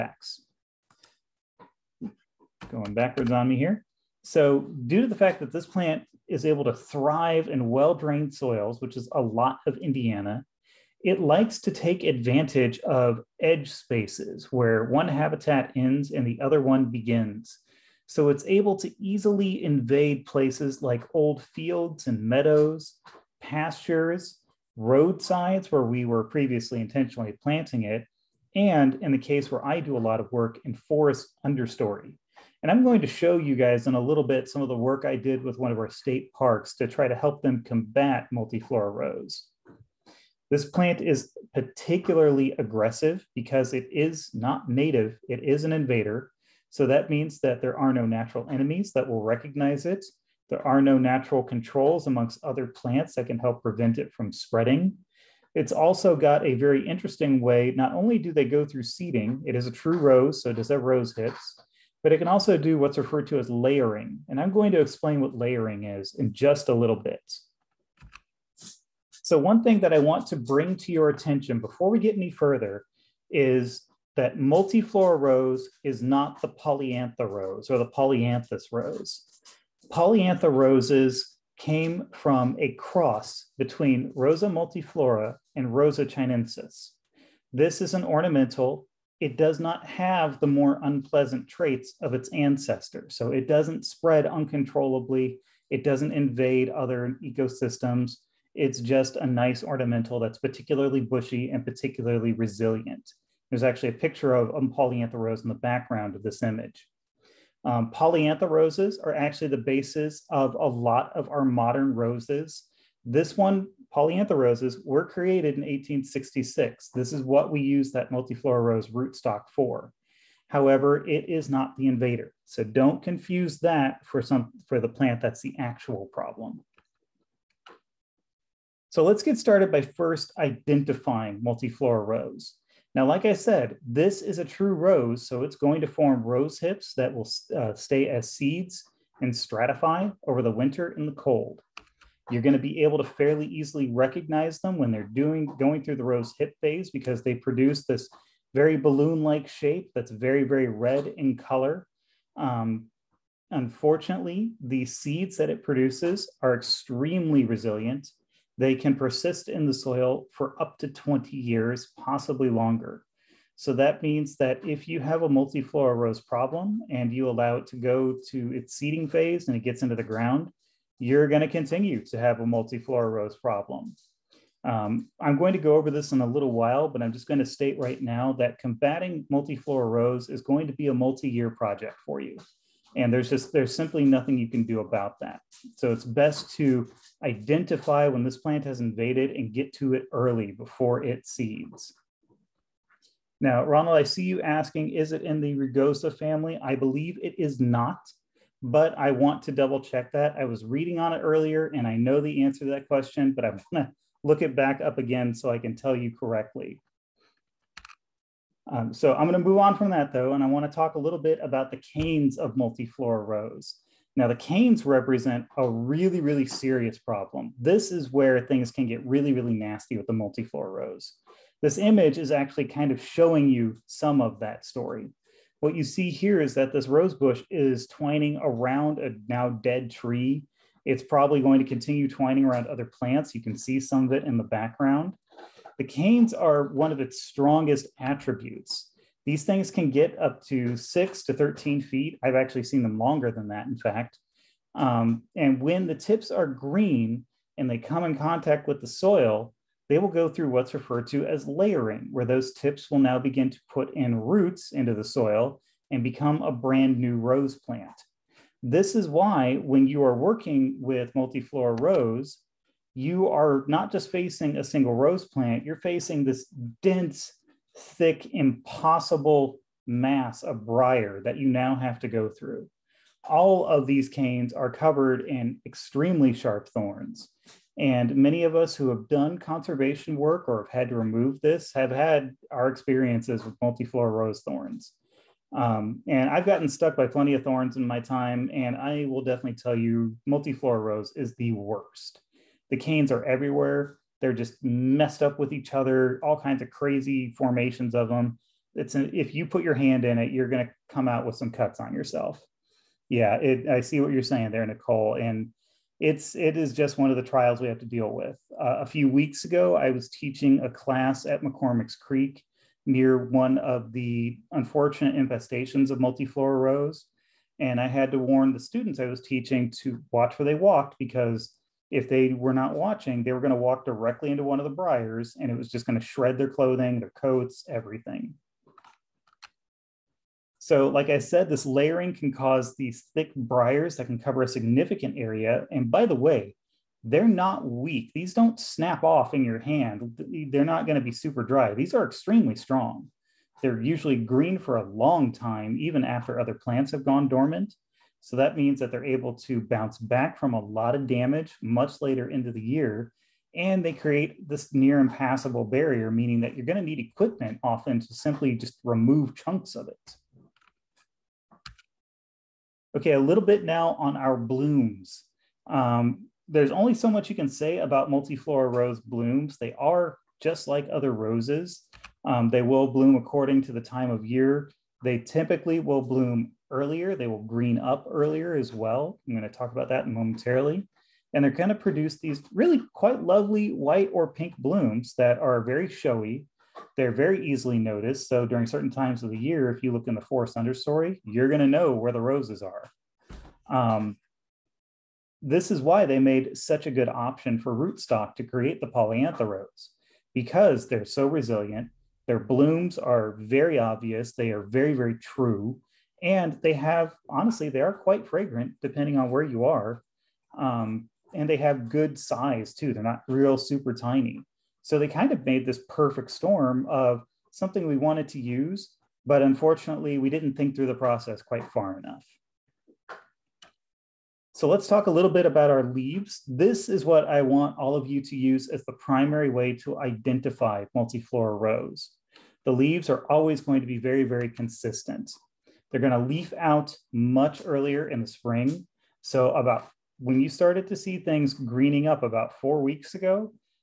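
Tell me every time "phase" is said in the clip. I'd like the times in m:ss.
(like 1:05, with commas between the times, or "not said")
2:26, 2:49.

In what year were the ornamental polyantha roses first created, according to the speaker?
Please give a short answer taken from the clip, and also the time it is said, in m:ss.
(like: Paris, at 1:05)
1866, at 1:55.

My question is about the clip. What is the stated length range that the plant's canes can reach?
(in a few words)
6 to 13 feet.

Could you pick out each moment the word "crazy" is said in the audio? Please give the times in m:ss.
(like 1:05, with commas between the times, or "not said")
4:56.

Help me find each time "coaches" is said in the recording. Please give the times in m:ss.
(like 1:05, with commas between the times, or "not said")
not said.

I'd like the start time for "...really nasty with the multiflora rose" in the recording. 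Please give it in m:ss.
3:39.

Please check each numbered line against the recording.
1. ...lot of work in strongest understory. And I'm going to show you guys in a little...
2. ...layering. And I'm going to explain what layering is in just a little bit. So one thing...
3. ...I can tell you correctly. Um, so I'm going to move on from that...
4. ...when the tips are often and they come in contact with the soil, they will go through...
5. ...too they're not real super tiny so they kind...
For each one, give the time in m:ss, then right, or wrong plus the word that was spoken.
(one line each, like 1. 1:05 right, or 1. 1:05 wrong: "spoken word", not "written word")
1. 0:30 wrong: "forest", not "strongest"
2. 1:03 right
3. 3:25 right
4. 4:05 wrong: "green", not "often"
5. 6:52 right.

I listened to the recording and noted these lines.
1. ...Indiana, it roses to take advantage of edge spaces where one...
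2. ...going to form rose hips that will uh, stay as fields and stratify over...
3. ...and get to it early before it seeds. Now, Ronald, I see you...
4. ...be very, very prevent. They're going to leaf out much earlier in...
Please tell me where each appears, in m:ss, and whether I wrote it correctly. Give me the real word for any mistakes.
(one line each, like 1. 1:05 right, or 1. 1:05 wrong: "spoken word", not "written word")
1. 0:09 wrong: "likes", not "roses"
2. 2:15 wrong: "seeds", not "fields"
3. 3:09 right
4. 7:13 wrong: "consistent", not "prevent".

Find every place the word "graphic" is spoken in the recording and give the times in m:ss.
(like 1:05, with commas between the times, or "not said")
not said.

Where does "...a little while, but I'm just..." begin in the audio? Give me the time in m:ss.
2:56.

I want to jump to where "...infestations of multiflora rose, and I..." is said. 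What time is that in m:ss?
5:15.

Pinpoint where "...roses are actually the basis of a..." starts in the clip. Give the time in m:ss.
1:48.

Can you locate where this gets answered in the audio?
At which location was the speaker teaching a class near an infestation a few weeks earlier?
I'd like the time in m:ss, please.
5:11.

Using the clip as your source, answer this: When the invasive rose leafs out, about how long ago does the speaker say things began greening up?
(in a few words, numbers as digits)
4 weeks ago.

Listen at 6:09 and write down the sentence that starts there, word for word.
They are just like other roses.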